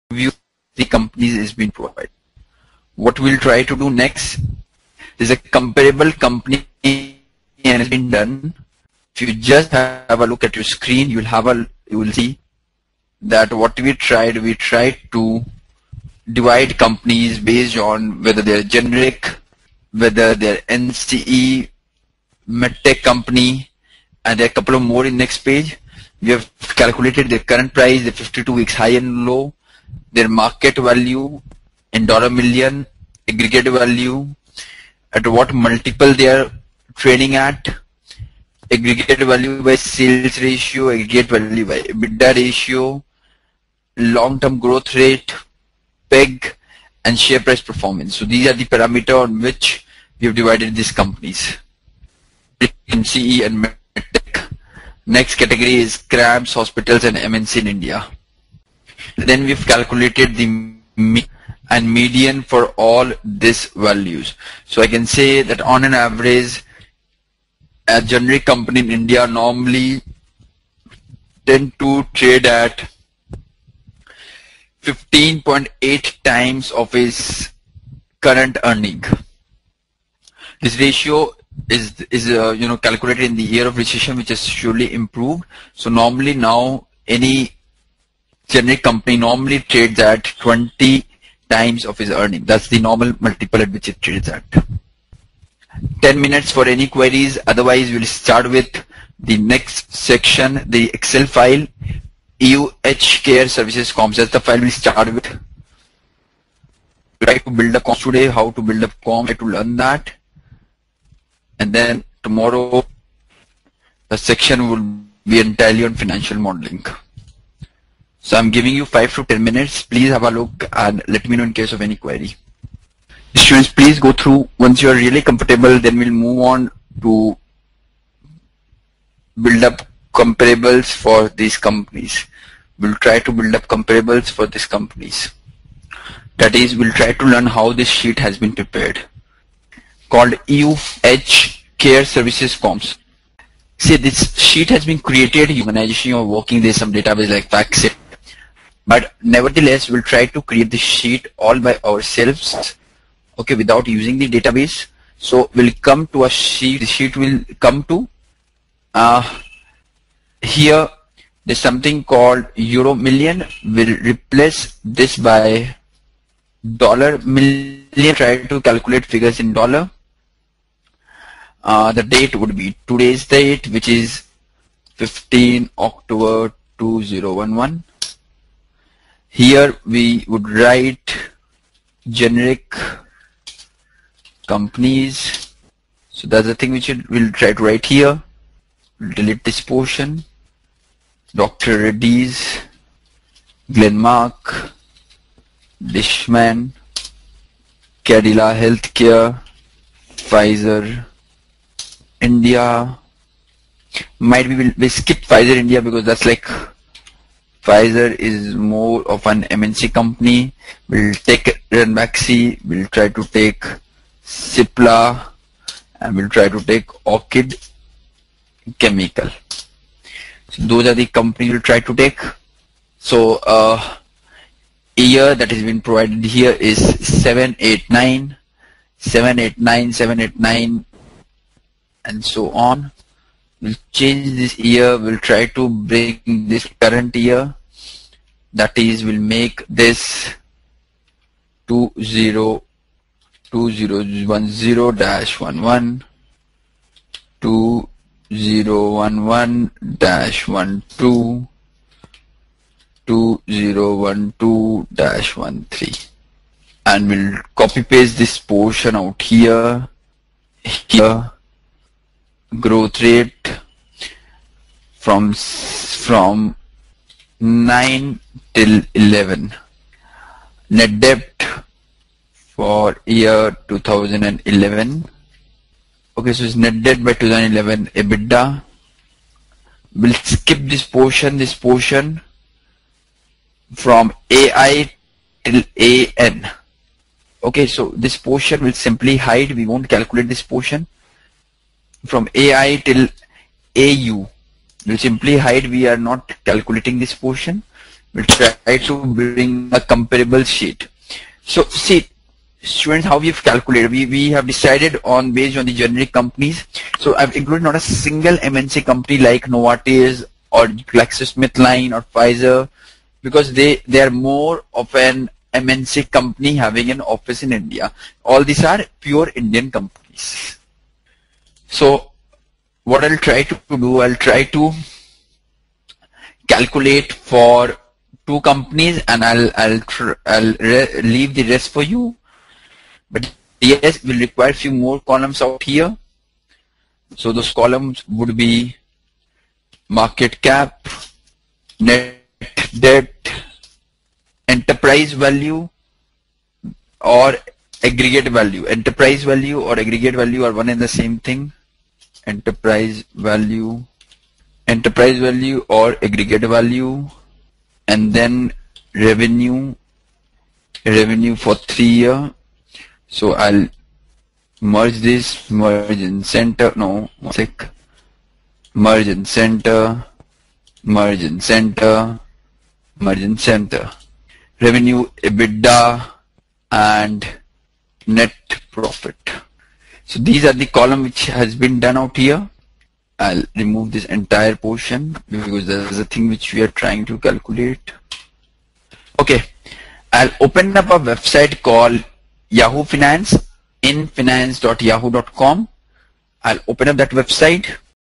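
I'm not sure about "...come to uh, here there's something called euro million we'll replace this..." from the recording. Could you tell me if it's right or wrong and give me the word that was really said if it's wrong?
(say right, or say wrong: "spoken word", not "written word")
right.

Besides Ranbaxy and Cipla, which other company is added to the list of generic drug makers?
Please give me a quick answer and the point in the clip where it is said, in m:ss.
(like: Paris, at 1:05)
Orchid Chemical, at 3:37.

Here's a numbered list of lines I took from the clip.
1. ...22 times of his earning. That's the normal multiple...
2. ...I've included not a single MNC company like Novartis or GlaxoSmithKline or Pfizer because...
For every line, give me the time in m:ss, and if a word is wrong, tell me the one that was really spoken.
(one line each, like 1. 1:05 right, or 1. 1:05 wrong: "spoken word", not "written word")
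1. 1:30 wrong: "20", not "22"
2. 5:07 right.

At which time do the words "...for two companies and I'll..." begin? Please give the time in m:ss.
5:27.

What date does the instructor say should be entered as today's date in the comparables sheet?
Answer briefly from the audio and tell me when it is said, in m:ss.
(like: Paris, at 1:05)
15 October 2011, at 2:54.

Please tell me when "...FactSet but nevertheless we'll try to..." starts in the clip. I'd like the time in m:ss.
2:27.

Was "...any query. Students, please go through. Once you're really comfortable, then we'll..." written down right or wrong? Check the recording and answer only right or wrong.
right.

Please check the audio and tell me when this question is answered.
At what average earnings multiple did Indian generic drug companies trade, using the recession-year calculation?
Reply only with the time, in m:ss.
1:14.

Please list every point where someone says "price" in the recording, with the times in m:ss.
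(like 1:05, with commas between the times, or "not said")
0:27, 0:47.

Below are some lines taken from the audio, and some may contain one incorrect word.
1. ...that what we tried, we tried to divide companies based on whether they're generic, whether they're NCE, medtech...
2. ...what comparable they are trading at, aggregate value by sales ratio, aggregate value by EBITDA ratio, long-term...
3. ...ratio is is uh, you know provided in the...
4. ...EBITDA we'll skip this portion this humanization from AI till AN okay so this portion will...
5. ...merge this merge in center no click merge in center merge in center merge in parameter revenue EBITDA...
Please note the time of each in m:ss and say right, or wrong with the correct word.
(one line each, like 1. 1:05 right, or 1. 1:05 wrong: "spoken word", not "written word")
1. 0:13 right
2. 0:35 wrong: "multiple", not "comparable"
3. 1:20 wrong: "calculated", not "provided"
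4. 4:38 wrong: "portion", not "humanization"
5. 6:04 wrong: "center", not "parameter".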